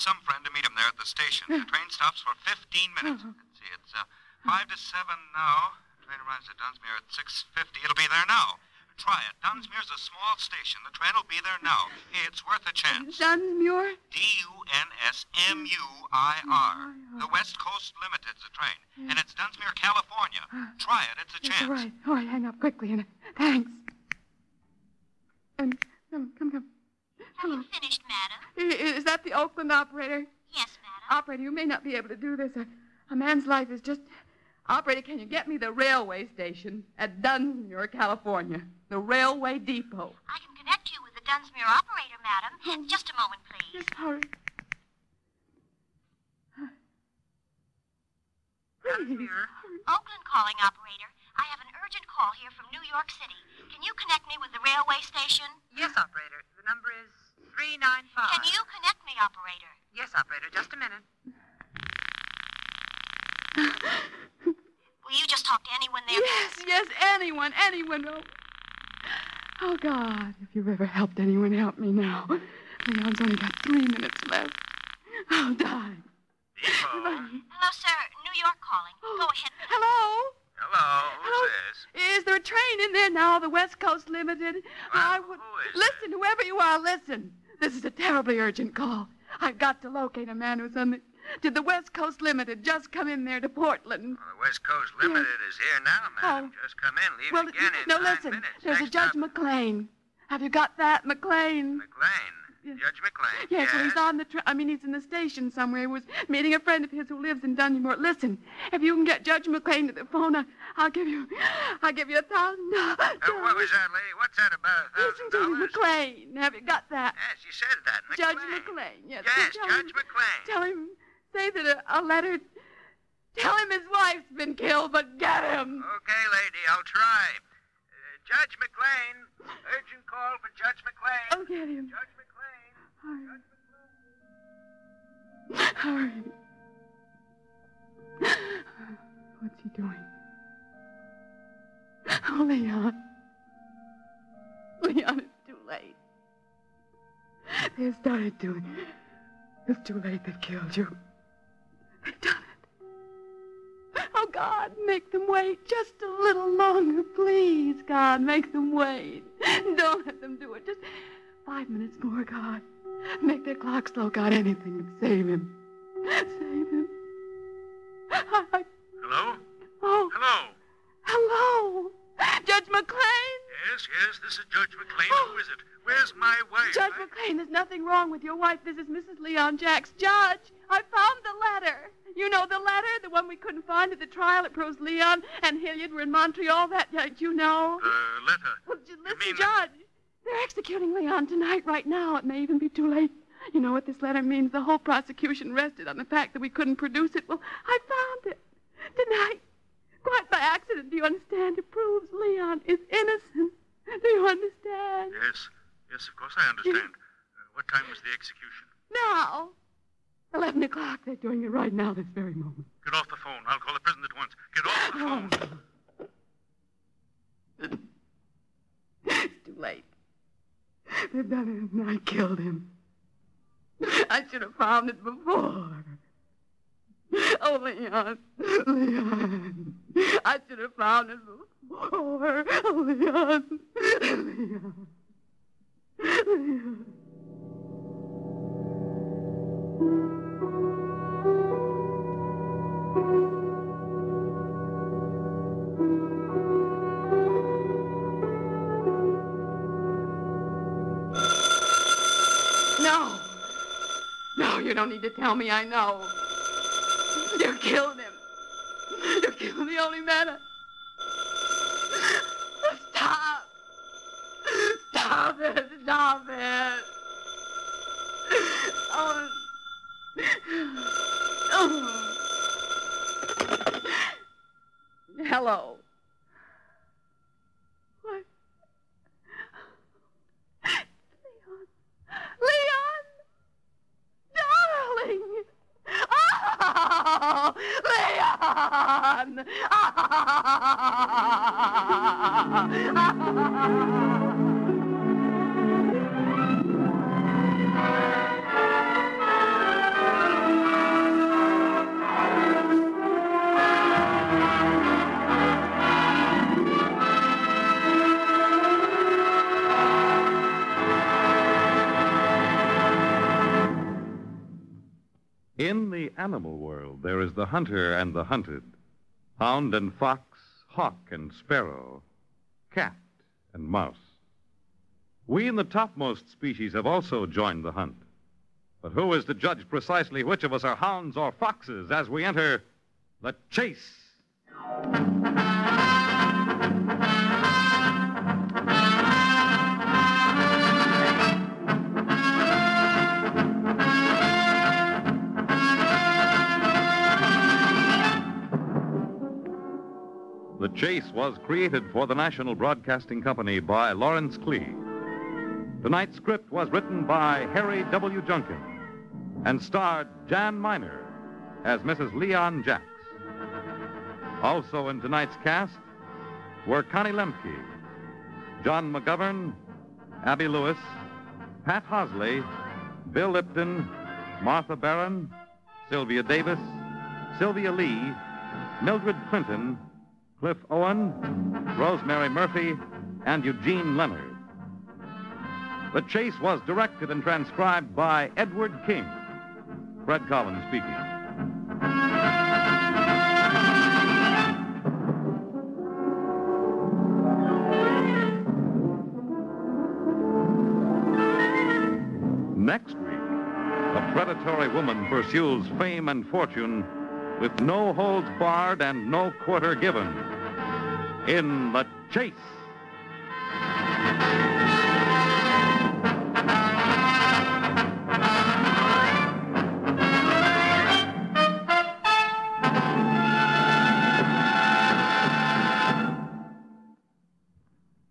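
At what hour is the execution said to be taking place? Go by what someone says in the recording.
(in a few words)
11 o'clock.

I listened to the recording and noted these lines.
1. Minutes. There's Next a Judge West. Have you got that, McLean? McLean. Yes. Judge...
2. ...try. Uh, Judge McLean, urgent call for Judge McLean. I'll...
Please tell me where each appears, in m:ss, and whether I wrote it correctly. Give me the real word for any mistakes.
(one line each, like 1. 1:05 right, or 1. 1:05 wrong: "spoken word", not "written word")
1. 1:38 wrong: "McLean", not "West"
2. 2:06 right.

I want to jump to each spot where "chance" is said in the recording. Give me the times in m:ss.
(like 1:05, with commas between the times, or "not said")
0:12, 0:21.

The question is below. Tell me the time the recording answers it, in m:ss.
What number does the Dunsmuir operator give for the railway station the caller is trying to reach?
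0:57.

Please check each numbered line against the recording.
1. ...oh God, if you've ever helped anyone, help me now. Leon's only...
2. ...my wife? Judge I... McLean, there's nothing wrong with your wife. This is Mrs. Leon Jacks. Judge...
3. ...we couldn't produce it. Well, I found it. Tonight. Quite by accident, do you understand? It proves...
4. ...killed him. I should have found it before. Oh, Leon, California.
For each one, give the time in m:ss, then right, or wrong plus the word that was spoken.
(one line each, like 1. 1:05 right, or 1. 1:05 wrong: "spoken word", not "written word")
1. 1:09 right
2. 2:56 right
3. 3:16 right
4. 3:41 wrong: "Leon", not "California".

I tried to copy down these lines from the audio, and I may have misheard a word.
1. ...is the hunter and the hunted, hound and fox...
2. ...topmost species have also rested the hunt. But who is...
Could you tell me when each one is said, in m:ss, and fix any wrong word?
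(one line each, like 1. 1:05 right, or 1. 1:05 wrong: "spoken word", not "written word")
1. 5:17 right
2. 5:25 wrong: "joined", not "rested".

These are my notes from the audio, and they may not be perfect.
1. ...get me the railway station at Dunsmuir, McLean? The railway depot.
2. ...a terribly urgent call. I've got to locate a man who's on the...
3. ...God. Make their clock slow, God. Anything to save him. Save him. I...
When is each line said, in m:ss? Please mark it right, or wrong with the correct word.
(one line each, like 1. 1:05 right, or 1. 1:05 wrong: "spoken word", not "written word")
1. 0:35 wrong: "California", not "McLean"
2. 1:27 right
3. 2:42 right.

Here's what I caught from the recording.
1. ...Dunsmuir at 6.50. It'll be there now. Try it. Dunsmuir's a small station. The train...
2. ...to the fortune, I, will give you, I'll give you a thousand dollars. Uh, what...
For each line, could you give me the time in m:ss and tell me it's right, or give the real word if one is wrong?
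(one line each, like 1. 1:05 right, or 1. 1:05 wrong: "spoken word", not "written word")
1. 0:06 right
2. 1:49 wrong: "phone", not "fortune".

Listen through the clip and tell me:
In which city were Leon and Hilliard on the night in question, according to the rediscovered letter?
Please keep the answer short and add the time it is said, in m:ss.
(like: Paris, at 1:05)
Montreal, at 3:06.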